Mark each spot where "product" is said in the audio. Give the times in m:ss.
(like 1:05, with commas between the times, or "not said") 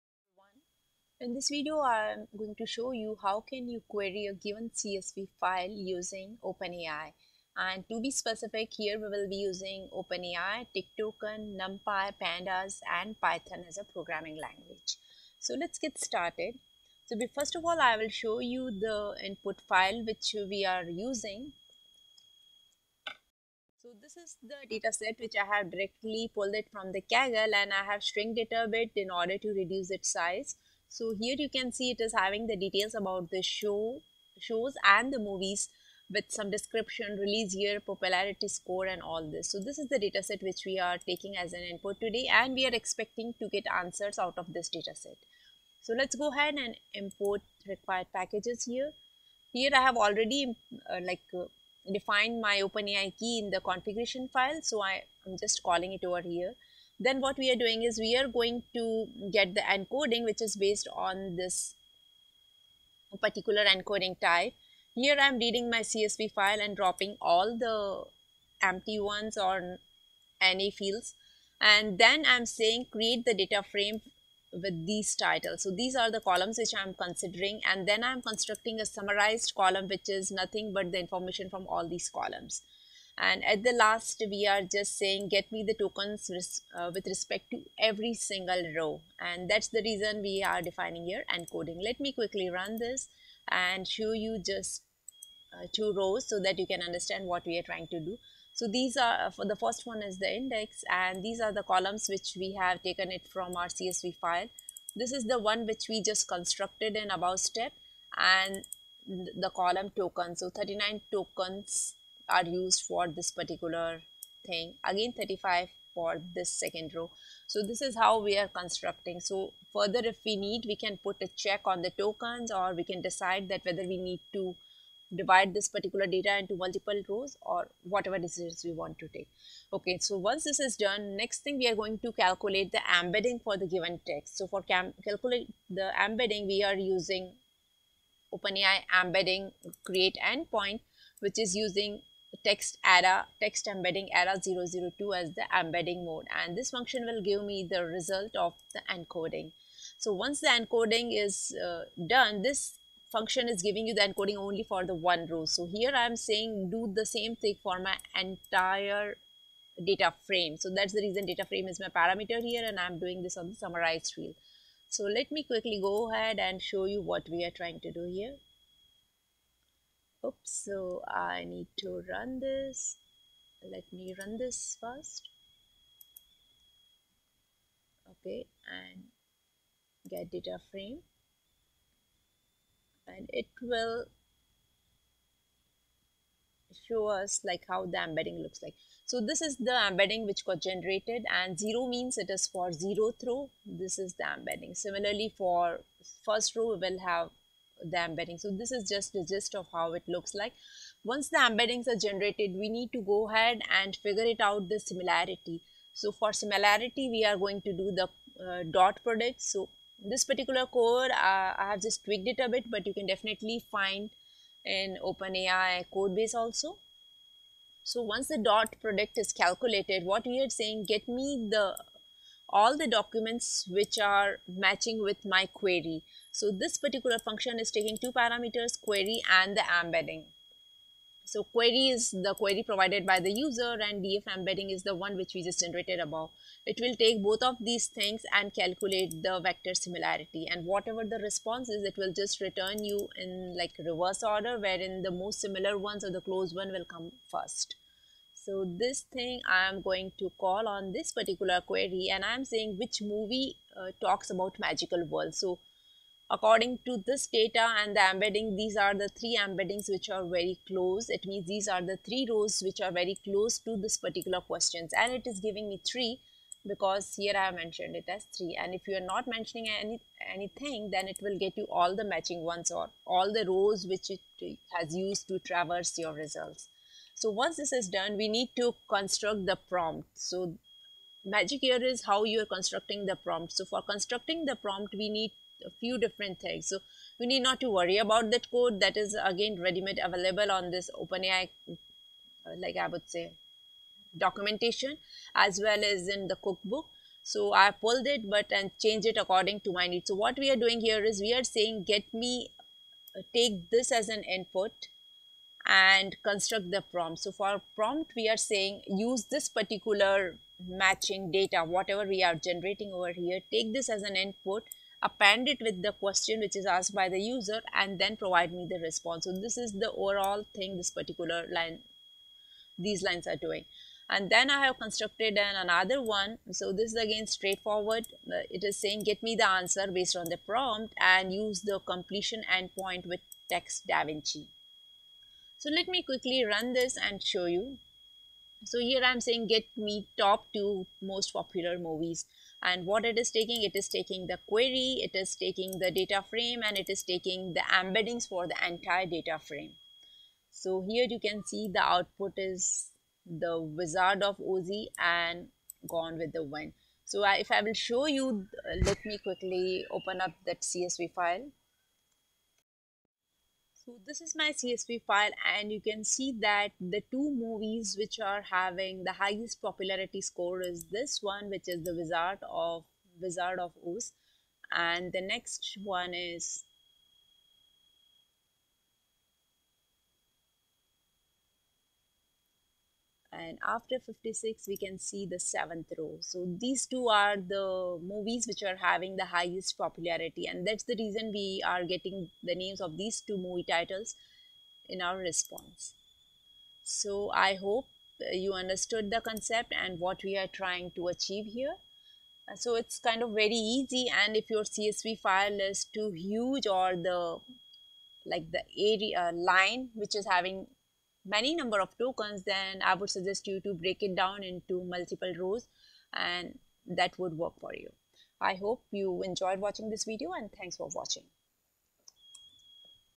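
3:29, 3:38.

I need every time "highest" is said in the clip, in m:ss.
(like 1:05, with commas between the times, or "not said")
6:09, 6:29.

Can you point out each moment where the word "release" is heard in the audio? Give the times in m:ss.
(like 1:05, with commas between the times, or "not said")
0:37.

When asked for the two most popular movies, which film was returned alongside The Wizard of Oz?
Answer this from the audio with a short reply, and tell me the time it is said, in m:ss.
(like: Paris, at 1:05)
Gone with the Wind, at 5:55.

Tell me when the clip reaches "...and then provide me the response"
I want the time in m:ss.
5:17.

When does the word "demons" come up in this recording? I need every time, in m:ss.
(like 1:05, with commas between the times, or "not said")
not said.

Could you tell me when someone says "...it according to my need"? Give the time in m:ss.
4:59.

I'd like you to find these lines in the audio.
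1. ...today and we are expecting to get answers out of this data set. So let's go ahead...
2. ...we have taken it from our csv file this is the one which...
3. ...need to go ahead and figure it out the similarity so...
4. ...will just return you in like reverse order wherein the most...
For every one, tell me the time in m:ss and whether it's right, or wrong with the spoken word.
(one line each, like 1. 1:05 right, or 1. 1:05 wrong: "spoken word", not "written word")
1. 0:42 right
2. 1:42 right
3. 3:22 right
4. 4:01 right.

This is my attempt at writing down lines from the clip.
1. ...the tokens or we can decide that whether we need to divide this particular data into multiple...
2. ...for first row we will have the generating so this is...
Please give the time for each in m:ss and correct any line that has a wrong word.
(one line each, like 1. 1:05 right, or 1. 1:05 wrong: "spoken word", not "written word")
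1. 2:01 right
2. 3:15 wrong: "embedding", not "generating".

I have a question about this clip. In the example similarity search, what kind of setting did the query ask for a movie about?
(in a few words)
magical world.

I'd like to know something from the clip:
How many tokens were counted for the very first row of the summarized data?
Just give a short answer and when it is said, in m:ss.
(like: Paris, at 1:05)
39, at 1:50.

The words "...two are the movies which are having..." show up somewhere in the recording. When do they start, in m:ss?
6:26.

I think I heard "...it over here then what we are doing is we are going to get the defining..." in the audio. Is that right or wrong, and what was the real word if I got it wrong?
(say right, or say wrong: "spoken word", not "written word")
wrong: "encoding", not "defining".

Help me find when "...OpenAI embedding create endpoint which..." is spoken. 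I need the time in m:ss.
2:18.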